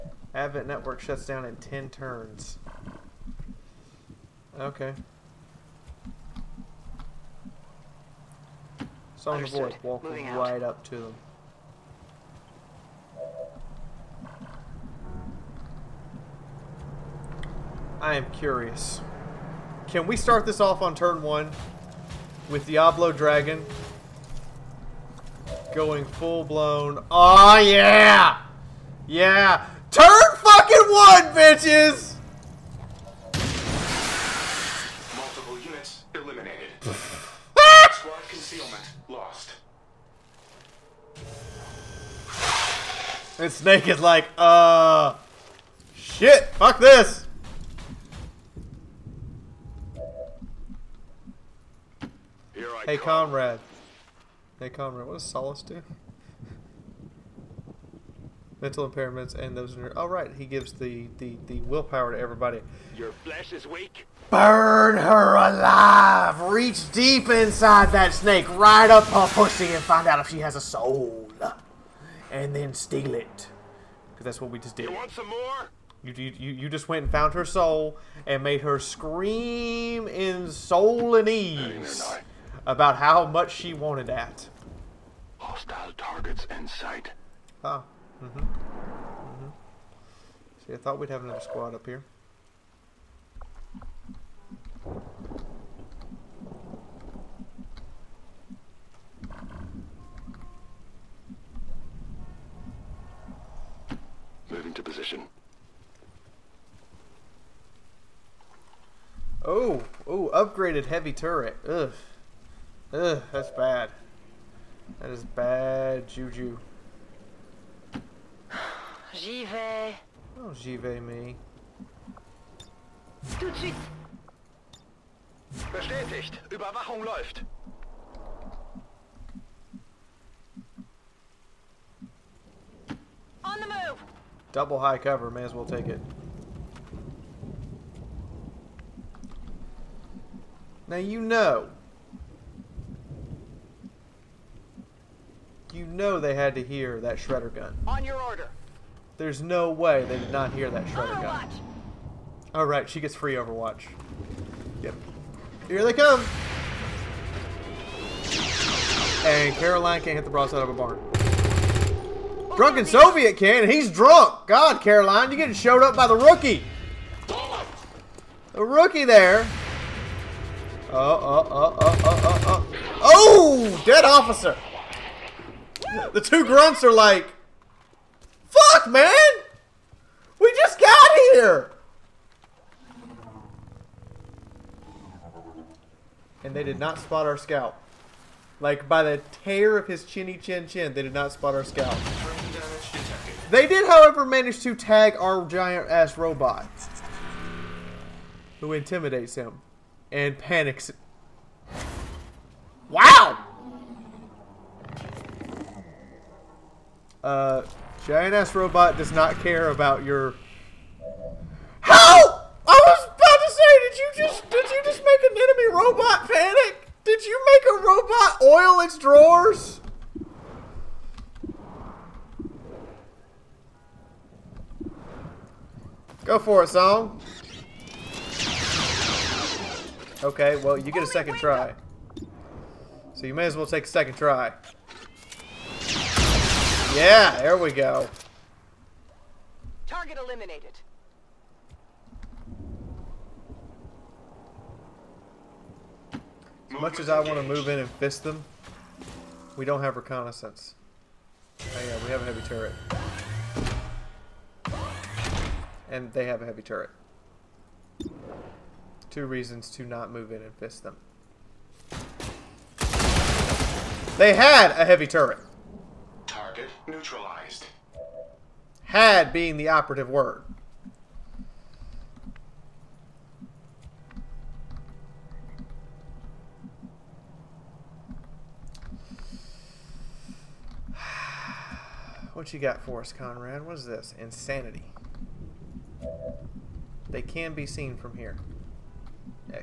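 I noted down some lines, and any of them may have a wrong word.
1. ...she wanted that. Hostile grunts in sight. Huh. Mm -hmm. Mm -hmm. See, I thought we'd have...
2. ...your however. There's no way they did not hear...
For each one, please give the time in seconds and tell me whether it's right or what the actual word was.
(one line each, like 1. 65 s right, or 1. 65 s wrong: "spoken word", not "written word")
1. 83 s wrong: "targets", not "grunts"
2. 148 s wrong: "order", not "however".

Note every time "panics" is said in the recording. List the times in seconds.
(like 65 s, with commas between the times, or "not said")
200 s, 216 s.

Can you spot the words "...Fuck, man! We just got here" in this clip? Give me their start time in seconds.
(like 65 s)
178 s.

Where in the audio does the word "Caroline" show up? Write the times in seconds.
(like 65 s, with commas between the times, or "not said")
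159 s, 164 s.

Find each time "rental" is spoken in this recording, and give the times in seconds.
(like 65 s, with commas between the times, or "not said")
not said.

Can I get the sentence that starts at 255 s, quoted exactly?
And they have a heavy turret.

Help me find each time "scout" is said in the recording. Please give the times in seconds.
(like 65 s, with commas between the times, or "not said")
187 s, 191 s.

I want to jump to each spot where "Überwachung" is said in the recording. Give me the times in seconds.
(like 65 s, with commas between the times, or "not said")
126 s.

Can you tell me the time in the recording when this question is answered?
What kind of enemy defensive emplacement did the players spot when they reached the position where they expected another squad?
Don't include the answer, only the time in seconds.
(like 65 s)
110 s.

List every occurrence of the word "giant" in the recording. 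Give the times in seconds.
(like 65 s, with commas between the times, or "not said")
195 s, 208 s.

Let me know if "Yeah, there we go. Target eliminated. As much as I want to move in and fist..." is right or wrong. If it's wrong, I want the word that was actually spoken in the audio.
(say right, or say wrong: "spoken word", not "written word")
right.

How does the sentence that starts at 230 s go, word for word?
Okay, well, you get a second try.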